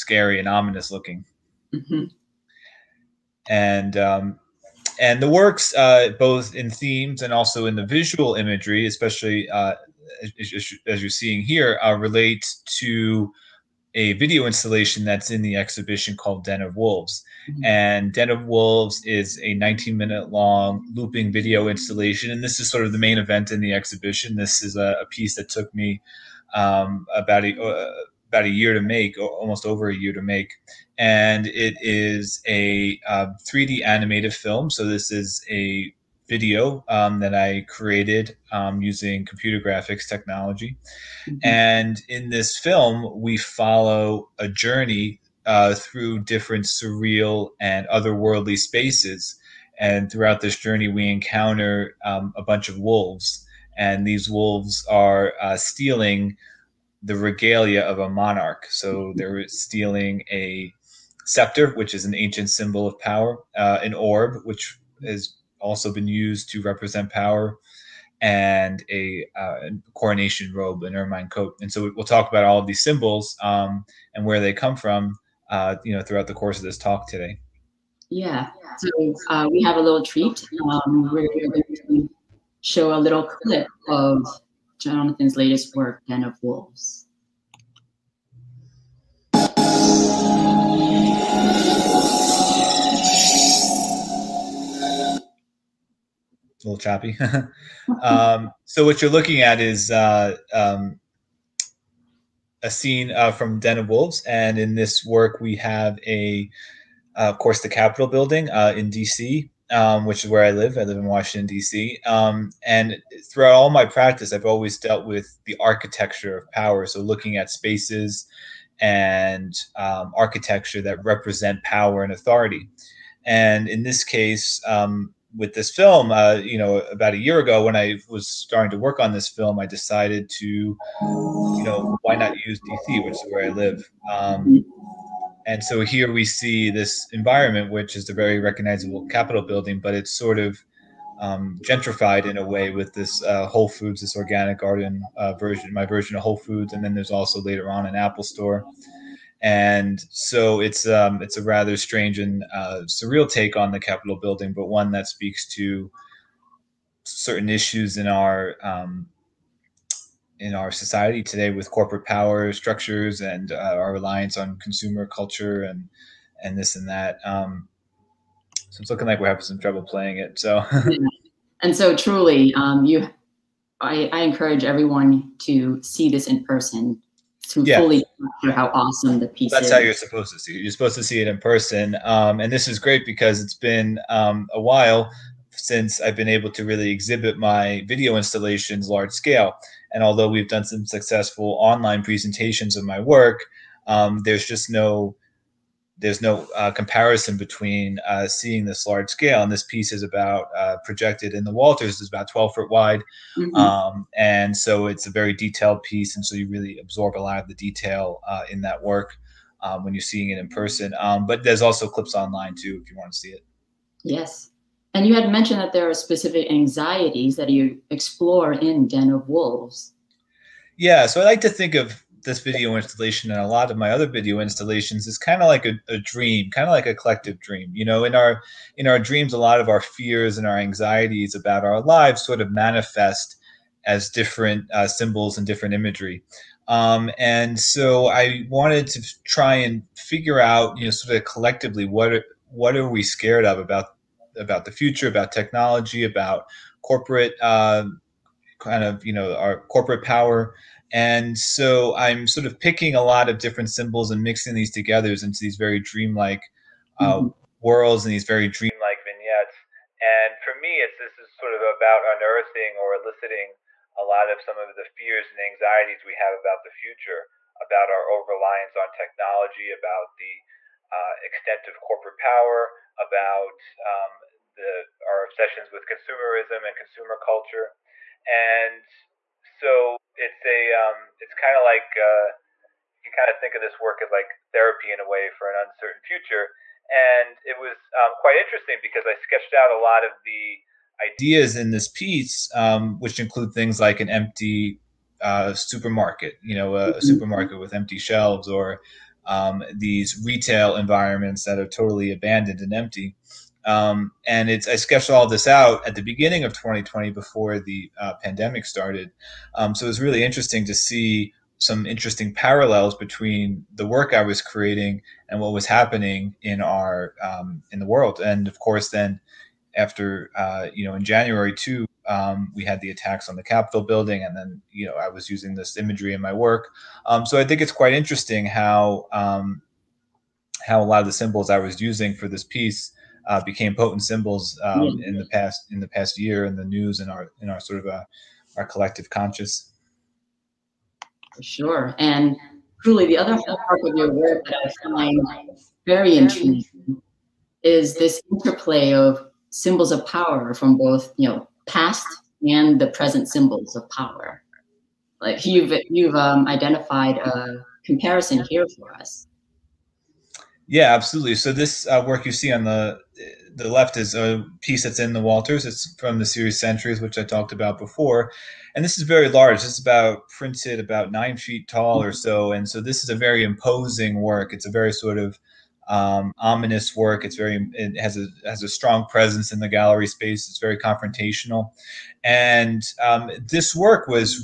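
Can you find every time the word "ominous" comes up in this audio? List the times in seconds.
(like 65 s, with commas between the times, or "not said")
0 s, 376 s.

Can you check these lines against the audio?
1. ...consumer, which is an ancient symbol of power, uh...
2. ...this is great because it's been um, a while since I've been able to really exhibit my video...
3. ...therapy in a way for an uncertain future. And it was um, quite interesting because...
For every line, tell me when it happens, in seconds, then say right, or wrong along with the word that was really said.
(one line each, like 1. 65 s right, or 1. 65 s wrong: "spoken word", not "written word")
1. 61 s wrong: "scepter", not "consumer"
2. 182 s right
3. 284 s right.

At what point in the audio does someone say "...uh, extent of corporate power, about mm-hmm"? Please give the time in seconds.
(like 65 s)
270 s.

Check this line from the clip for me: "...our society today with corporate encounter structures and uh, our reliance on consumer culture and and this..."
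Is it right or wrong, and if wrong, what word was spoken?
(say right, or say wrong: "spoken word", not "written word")
wrong: "power", not "encounter".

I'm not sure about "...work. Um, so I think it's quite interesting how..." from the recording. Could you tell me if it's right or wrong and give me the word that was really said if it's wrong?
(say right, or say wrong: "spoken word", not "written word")
right.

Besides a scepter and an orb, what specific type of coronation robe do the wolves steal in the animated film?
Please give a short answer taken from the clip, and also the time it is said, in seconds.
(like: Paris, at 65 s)
An ermine coat, at 70 s.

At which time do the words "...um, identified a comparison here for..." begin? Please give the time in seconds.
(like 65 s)
356 s.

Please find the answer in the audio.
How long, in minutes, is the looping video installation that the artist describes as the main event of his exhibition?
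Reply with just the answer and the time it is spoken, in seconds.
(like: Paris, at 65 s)
19 minutes, at 19 s.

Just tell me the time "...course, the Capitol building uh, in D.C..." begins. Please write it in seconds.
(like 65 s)
107 s.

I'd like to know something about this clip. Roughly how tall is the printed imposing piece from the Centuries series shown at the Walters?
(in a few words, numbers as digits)
About 9 feet.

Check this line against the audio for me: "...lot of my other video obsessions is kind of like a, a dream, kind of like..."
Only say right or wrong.
wrong.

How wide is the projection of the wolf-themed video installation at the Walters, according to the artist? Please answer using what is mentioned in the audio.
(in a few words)
About 12 feet.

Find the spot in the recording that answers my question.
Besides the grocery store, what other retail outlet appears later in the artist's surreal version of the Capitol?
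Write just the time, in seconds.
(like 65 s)
147 s.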